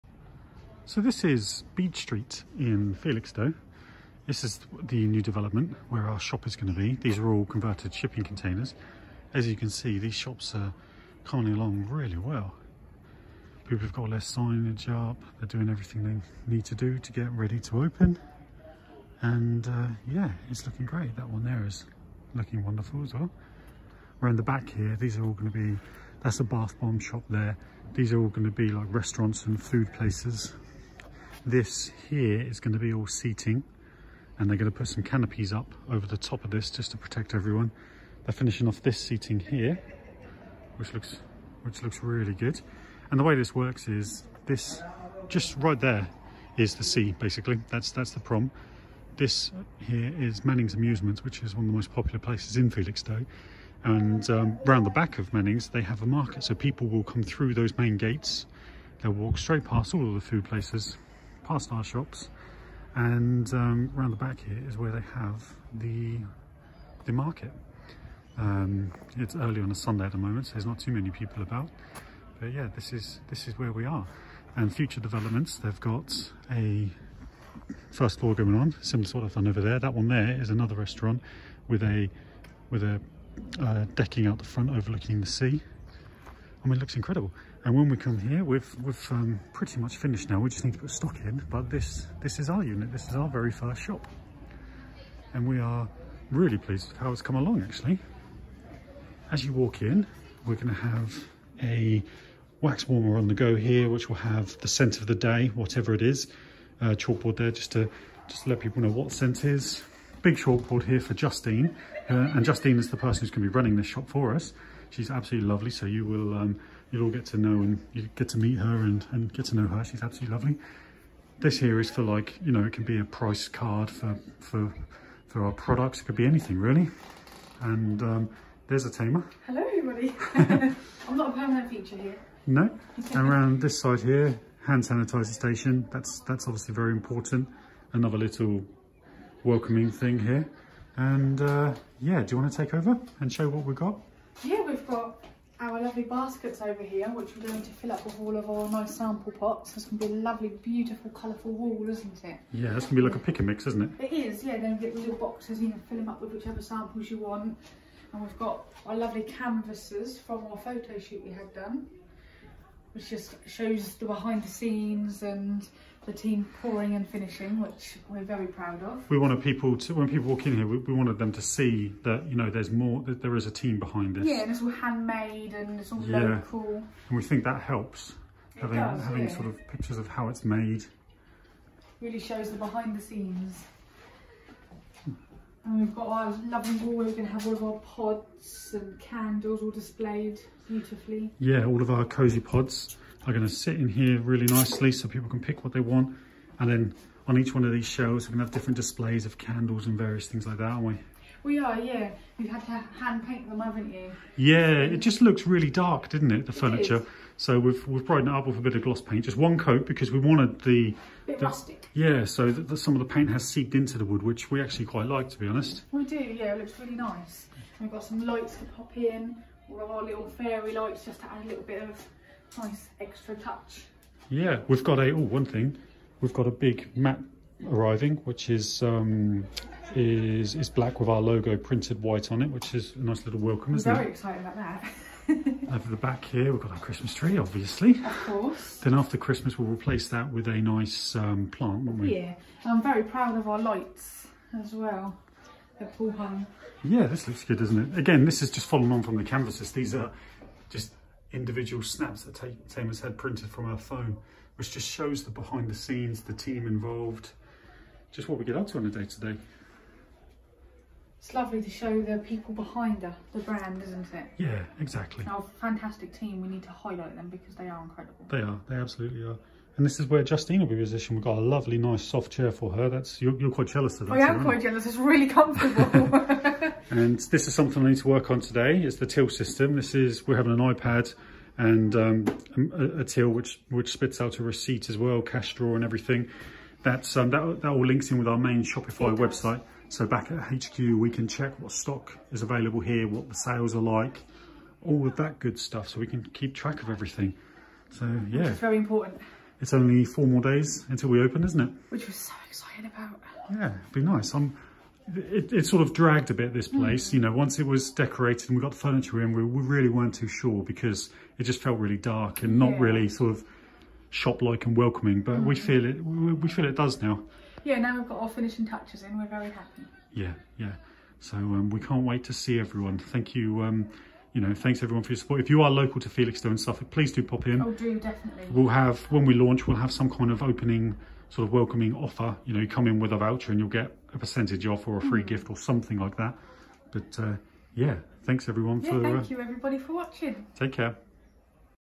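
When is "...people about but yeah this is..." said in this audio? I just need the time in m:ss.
1:11.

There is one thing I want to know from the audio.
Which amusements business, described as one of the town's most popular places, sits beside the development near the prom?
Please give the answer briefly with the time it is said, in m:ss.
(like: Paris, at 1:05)
Manning's Amusements, at 0:50.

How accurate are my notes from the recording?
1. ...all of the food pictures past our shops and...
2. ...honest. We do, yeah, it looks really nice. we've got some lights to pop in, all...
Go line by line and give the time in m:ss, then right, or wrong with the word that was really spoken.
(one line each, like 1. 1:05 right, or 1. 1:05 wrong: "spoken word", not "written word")
1. 0:59 wrong: "places", not "pictures"
2. 3:35 right.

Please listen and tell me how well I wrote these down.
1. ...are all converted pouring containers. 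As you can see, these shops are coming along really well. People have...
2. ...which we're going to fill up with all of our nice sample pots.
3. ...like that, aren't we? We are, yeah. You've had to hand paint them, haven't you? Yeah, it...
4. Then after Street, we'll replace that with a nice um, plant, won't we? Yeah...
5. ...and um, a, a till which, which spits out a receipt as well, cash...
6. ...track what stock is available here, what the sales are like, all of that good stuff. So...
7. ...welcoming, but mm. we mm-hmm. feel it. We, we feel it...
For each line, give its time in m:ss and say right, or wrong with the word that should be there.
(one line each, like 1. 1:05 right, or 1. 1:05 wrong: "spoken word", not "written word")
1. 0:07 wrong: "shipping", not "pouring"
2. 2:27 right
3. 3:20 right
4. 3:58 wrong: "Christmas", not "Street"
5. 4:41 right
6. 4:51 wrong: "check", not "track"
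7. 5:14 right.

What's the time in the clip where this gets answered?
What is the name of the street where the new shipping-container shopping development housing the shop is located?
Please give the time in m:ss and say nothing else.
0:01.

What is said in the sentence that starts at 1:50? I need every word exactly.
Big chalkboard here for Justine, uh, and Justine is the person who's gonna be running this shop for us.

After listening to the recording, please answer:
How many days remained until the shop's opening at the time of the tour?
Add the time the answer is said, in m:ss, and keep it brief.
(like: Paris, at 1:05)
4, at 5:00.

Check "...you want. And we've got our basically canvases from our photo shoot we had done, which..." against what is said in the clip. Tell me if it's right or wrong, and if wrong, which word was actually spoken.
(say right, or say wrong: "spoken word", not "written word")
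wrong: "lovely", not "basically".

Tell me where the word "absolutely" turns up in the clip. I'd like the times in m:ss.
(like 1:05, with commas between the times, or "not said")
1:55, 2:00, 4:28.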